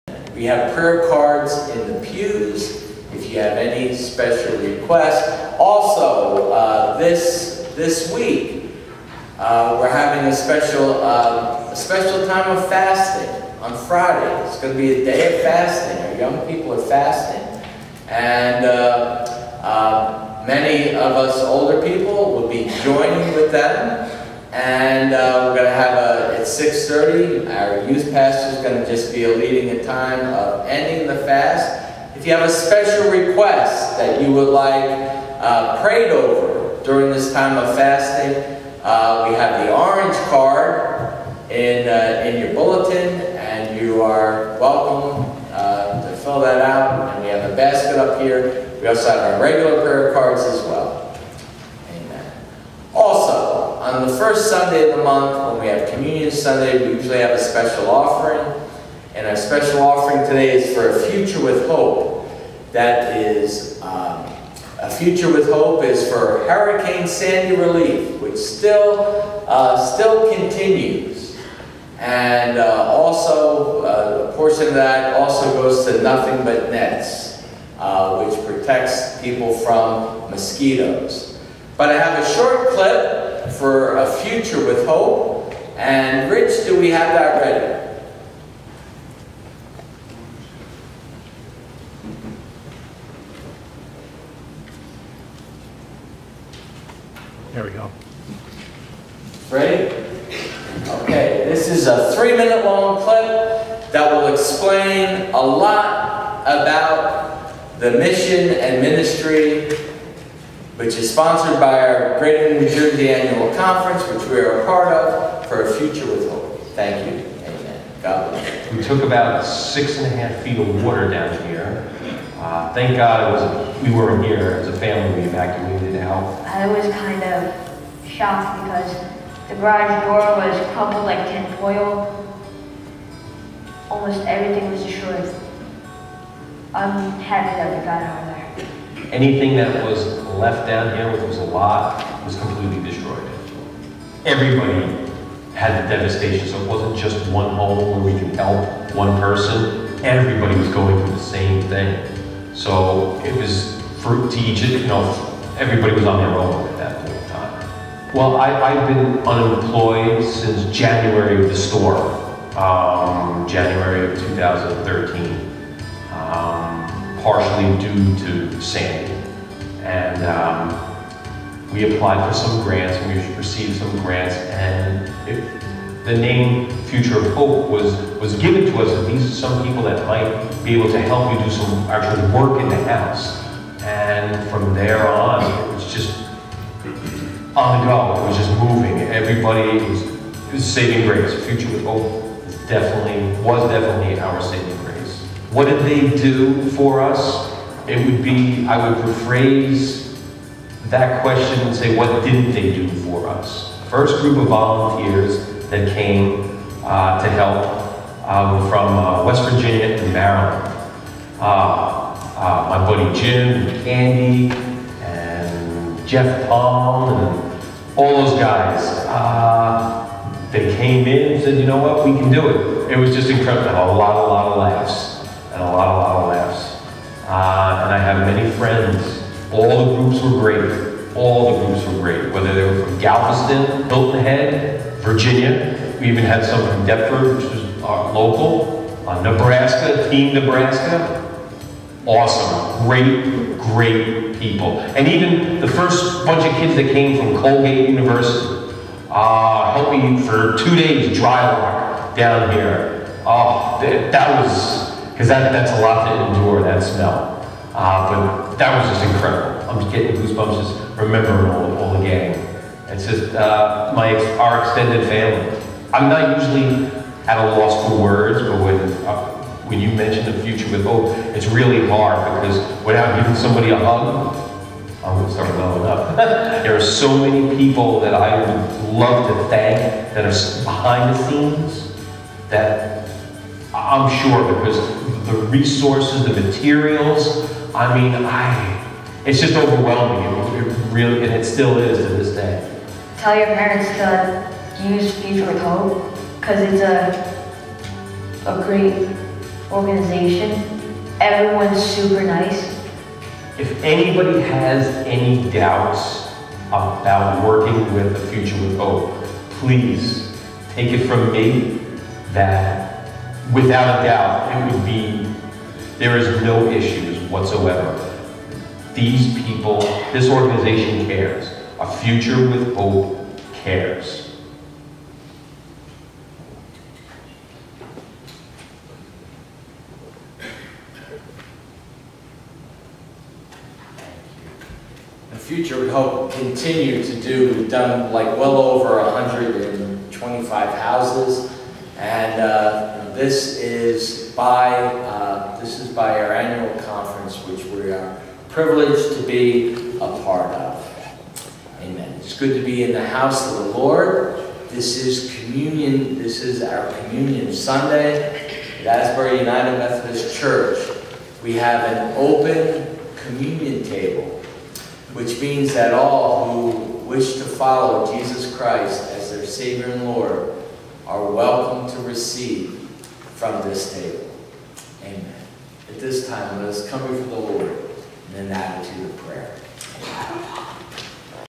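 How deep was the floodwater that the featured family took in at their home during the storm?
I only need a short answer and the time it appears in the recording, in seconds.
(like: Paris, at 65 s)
6.5 feet, at 119 s.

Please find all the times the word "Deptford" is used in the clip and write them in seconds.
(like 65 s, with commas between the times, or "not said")
236 s.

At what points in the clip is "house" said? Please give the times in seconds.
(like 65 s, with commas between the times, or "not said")
182 s, 340 s, 353 s.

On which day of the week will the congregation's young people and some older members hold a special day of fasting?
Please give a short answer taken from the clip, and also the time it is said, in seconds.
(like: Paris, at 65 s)
Friday, at 13 s.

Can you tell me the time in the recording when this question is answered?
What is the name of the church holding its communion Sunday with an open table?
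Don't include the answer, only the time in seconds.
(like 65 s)
358 s.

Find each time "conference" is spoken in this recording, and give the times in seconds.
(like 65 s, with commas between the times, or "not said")
113 s, 346 s.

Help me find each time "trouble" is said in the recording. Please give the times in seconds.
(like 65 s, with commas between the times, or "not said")
not said.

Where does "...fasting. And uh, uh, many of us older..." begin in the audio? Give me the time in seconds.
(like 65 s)
16 s.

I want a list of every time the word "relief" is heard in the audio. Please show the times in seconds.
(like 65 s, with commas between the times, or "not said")
67 s.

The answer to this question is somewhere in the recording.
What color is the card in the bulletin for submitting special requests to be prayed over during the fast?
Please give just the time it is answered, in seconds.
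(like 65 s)
39 s.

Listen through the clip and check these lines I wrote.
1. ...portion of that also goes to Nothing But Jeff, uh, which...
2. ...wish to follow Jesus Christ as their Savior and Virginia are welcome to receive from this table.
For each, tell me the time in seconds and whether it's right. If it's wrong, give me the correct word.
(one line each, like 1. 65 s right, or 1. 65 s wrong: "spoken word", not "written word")
1. 74 s wrong: "Nets", not "Jeff"
2. 367 s wrong: "Lord", not "Virginia".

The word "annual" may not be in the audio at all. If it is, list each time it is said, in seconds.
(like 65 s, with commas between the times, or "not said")
113 s, 346 s.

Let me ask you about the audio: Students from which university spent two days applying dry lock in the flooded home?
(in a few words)
Colgate University.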